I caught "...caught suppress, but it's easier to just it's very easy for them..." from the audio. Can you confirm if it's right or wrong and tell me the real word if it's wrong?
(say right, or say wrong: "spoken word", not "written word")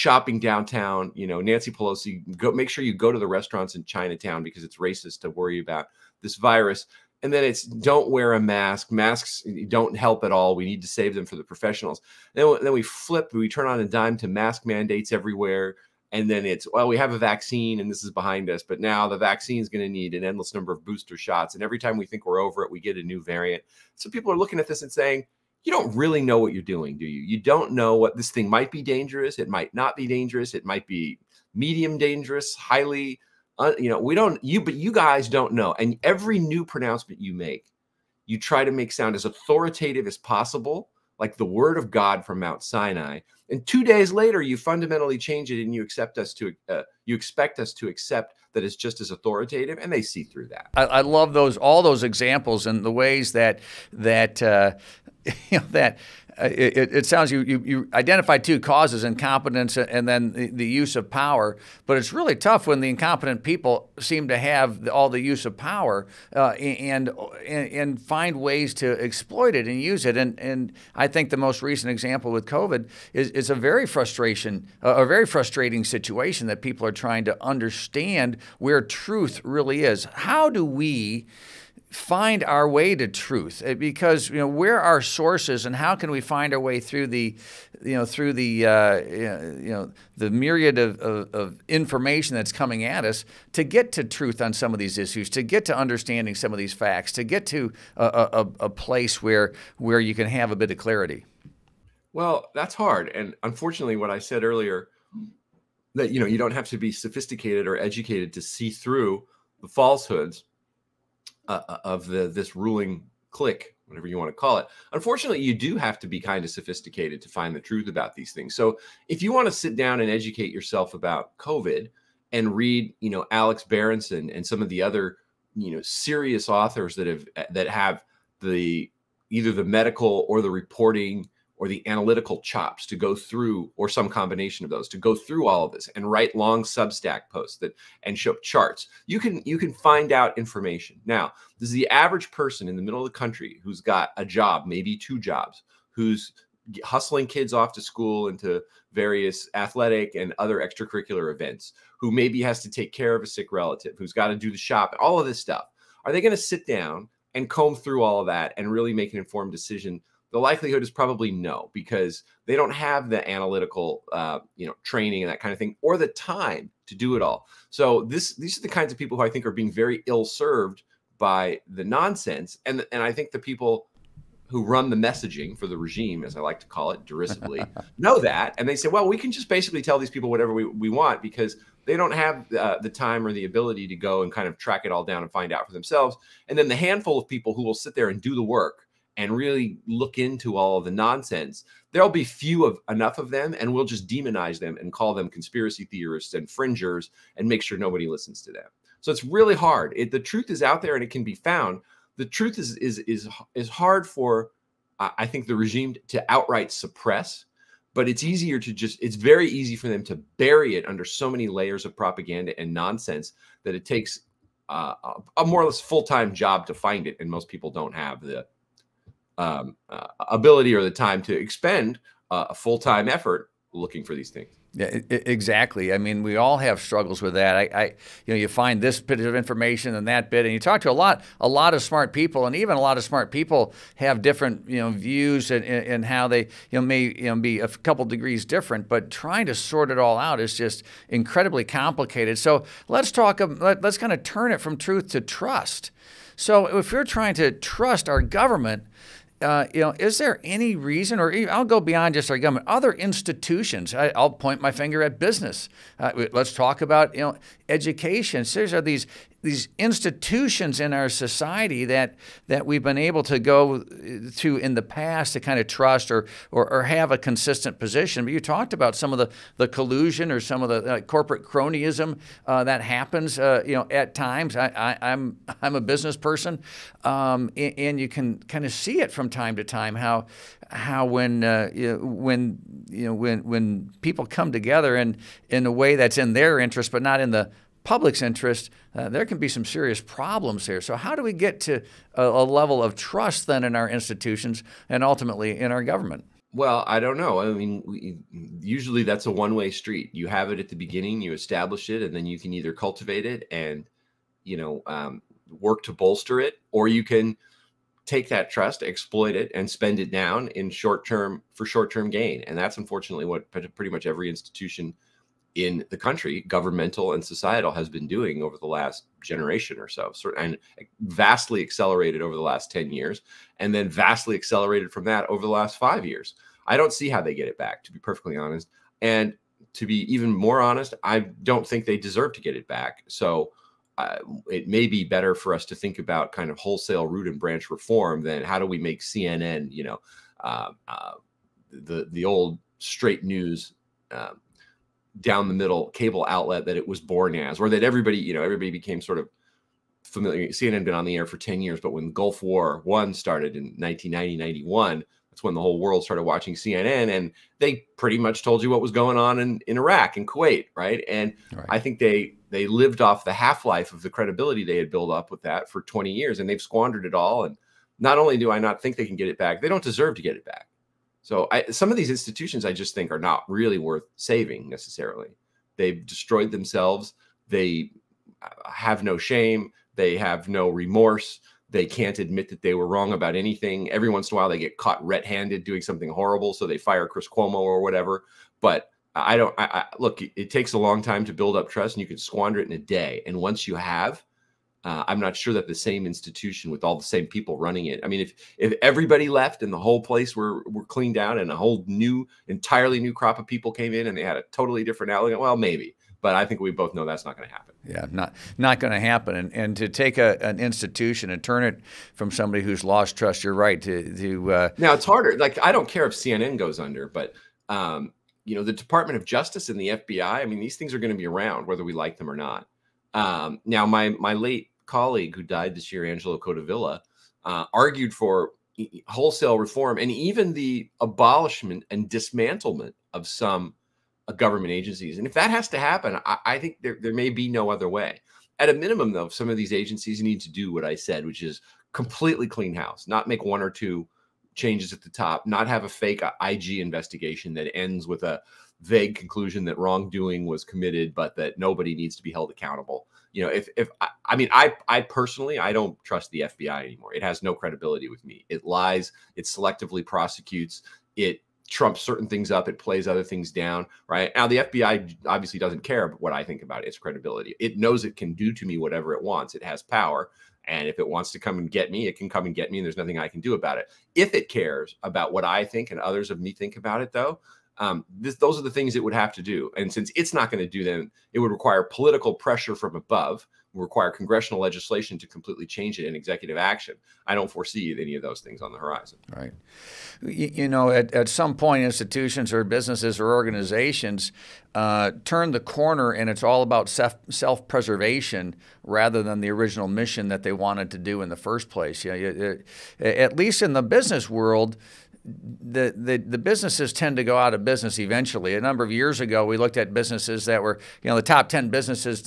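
wrong: "outright", not "caught".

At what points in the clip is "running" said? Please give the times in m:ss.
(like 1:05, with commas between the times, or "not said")
6:37.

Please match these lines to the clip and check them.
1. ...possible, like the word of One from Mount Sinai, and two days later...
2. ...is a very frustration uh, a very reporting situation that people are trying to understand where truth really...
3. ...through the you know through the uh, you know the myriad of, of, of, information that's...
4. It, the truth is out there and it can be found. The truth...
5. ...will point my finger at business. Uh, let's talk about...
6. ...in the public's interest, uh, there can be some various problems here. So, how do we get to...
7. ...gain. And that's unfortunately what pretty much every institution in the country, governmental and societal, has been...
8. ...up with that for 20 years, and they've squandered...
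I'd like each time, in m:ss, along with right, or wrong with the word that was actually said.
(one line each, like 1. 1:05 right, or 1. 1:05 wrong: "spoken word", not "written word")
1. 0:40 wrong: "God", not "One"
2. 1:13 wrong: "frustrating", not "reporting"
3. 1:26 right
4. 3:19 right
5. 4:14 right
6. 4:47 wrong: "serious", not "various"
7. 5:12 right
8. 6:05 right.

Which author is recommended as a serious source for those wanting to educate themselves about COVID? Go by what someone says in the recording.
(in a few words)
Alex Berenson.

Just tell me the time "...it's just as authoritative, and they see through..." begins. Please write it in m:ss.
0:48.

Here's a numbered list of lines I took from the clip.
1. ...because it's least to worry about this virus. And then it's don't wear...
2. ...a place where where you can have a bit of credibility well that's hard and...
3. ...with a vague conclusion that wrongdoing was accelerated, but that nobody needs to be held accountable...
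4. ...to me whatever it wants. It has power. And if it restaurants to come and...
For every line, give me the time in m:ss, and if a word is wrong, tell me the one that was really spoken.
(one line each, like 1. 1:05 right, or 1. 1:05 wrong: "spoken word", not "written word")
1. 0:04 wrong: "racist", not "least"
2. 1:38 wrong: "clarity", not "credibility"
3. 7:28 wrong: "committed", not "accelerated"
4. 7:48 wrong: "wants", not "restaurants".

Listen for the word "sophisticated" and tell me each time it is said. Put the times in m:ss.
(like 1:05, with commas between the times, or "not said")
1:46, 1:56.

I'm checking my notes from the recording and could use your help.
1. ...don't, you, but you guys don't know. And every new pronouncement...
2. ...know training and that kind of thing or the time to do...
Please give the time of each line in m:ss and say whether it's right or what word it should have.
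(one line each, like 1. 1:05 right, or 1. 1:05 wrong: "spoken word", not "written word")
1. 0:34 right
2. 2:44 right.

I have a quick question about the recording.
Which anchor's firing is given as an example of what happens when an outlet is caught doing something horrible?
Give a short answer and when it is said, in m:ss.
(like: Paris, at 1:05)
Chris Cuomo, at 6:27.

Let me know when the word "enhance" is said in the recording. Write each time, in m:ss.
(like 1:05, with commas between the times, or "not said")
not said.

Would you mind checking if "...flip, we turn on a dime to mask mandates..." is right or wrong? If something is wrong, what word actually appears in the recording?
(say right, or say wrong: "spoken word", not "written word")
right.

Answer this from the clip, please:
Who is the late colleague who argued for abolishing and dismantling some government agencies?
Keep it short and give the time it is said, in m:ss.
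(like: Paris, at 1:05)
Angelo Codevilla, at 7:06.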